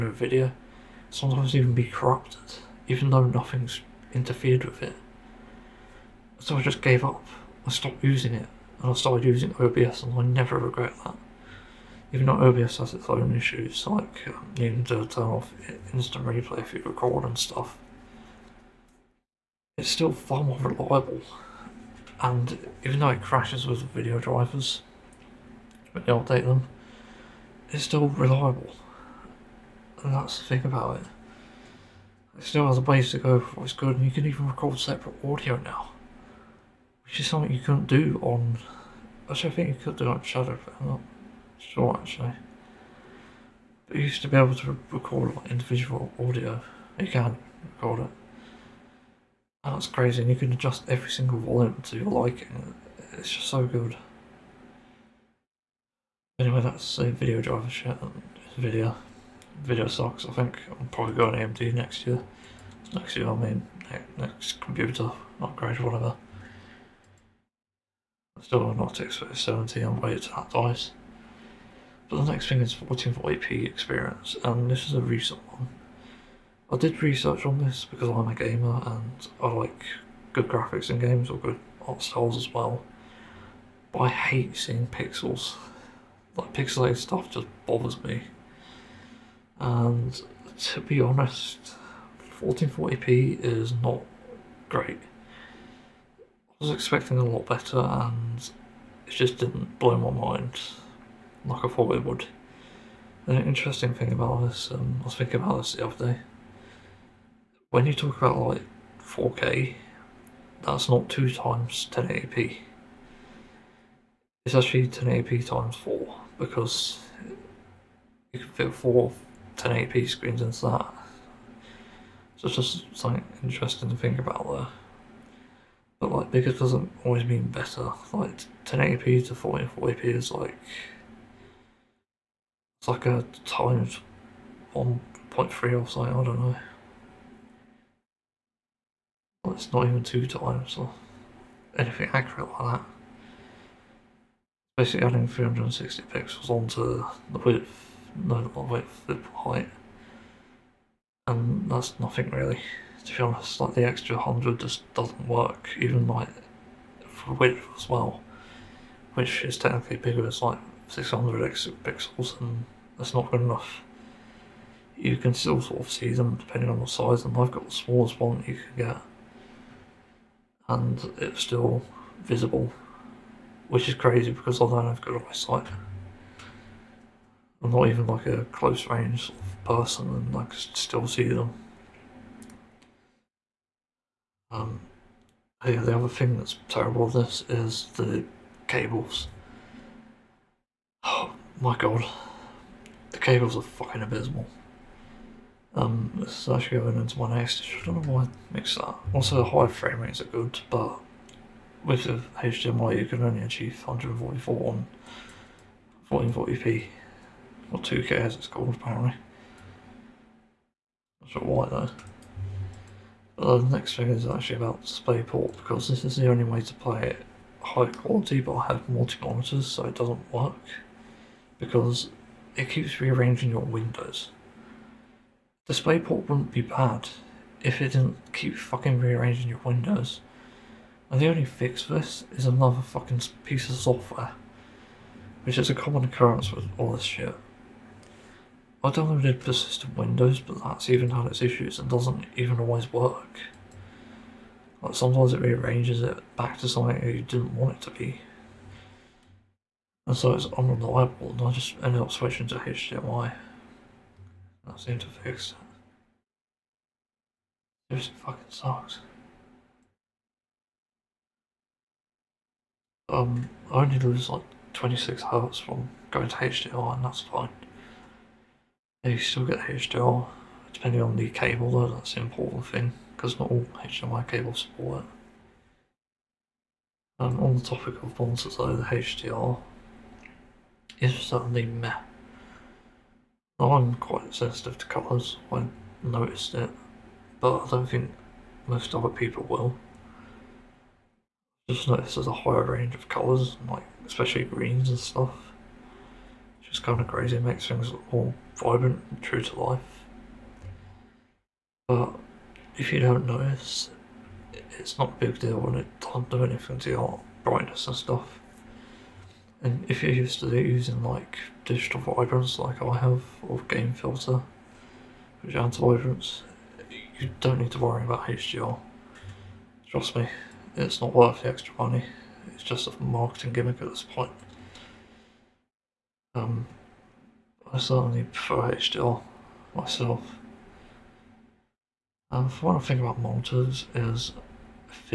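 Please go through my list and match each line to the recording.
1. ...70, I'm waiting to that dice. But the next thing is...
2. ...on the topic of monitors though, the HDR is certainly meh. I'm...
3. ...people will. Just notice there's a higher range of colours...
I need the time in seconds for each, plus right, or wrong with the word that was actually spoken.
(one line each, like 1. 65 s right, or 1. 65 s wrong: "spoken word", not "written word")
1. 69 s right
2. 277 s right
3. 289 s right.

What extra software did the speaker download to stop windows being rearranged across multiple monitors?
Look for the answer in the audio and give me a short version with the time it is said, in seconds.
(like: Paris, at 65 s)
persistent Windows, at 239 s.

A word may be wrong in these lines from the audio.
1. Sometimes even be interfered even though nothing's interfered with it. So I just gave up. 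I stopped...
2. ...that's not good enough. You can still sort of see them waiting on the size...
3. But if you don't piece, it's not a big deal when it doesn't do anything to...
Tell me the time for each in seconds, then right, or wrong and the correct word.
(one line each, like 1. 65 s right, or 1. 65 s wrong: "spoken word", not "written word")
1. 1 s wrong: "corrupted", not "interfered"
2. 162 s wrong: "depending", not "waiting"
3. 301 s wrong: "notice", not "piece".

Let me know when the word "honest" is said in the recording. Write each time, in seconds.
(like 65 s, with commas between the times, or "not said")
91 s, 153 s.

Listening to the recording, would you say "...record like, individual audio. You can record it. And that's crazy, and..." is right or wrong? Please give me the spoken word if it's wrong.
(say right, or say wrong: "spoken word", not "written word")
right.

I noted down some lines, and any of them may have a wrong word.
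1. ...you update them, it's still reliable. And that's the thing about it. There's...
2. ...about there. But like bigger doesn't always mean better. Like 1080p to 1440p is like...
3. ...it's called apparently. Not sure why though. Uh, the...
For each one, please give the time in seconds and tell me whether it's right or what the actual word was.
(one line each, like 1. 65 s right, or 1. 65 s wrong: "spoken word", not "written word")
1. 26 s right
2. 124 s right
3. 208 s right.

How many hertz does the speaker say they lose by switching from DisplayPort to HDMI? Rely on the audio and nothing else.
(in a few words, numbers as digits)
26.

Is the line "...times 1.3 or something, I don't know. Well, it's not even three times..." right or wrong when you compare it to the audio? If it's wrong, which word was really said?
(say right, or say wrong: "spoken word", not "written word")
wrong: "two", not "three".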